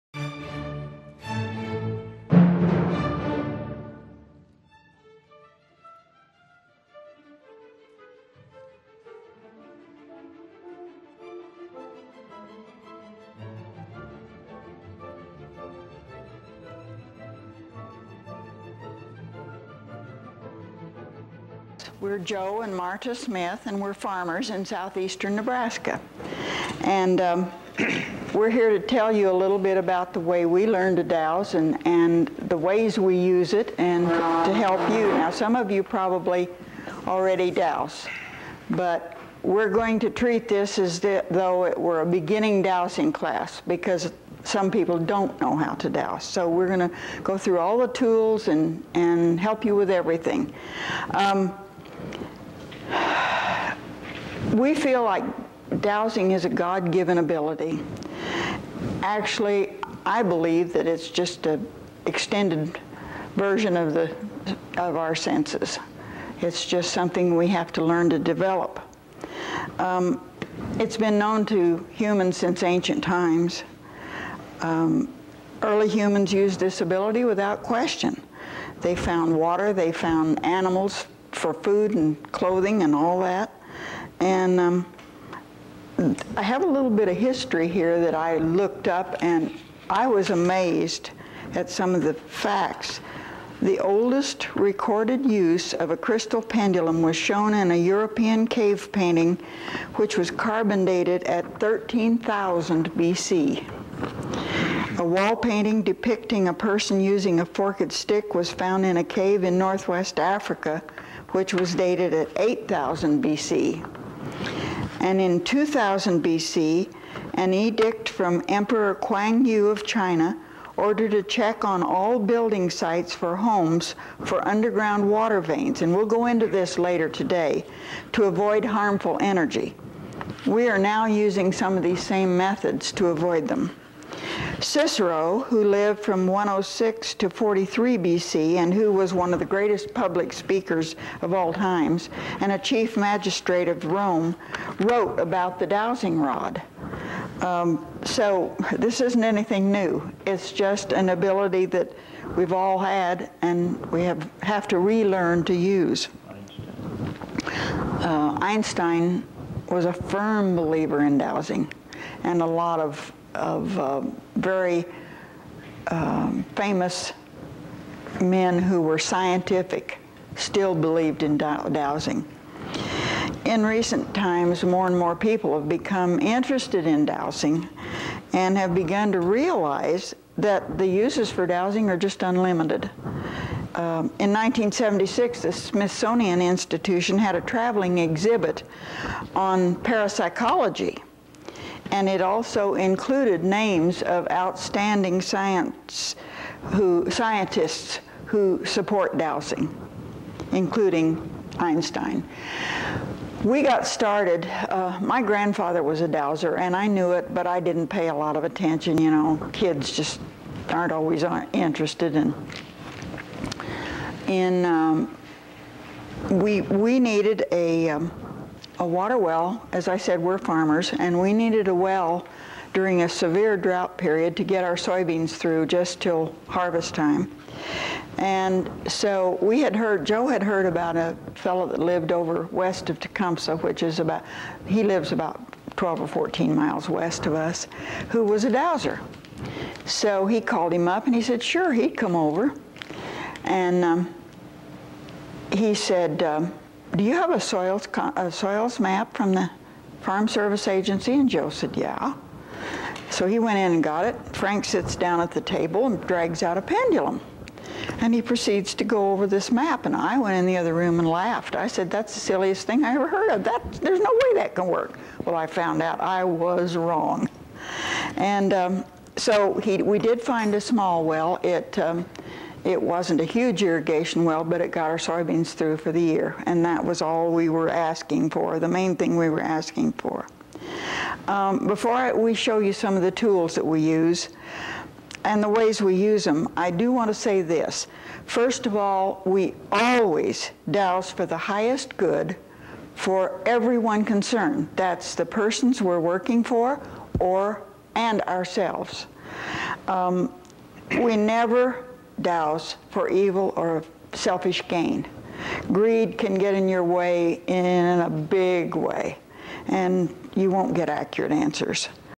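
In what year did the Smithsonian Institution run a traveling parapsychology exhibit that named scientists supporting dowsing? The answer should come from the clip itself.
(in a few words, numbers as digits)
1976.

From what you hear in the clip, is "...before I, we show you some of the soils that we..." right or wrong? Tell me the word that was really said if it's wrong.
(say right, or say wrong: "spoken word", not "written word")
wrong: "tools", not "soils".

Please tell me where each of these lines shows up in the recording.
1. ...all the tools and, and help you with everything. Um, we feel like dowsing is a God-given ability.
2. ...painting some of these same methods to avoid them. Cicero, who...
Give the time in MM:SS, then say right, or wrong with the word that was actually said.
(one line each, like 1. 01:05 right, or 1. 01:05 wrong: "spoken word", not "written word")
1. 00:47 right
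2. 02:11 wrong: "using", not "painting".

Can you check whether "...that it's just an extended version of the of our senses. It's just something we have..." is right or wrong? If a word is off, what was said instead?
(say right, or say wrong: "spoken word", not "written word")
right.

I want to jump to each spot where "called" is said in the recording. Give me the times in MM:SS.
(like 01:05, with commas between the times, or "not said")
04:00.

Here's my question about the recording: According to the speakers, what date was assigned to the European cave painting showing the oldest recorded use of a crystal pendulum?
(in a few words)
13,000 BC.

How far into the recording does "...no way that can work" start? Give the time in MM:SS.
04:23.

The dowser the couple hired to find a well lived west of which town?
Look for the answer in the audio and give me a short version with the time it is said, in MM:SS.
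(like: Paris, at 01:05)
Tecumseh, at 03:52.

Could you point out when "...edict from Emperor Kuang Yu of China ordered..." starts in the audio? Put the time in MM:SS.
01:57.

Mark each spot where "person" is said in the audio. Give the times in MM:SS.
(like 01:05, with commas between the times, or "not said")
01:46, 04:55.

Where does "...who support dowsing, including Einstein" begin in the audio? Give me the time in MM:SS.
03:18.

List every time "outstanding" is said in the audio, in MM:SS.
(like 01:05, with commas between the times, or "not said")
03:14.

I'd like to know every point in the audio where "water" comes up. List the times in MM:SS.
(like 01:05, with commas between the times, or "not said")
01:19, 02:05, 03:38.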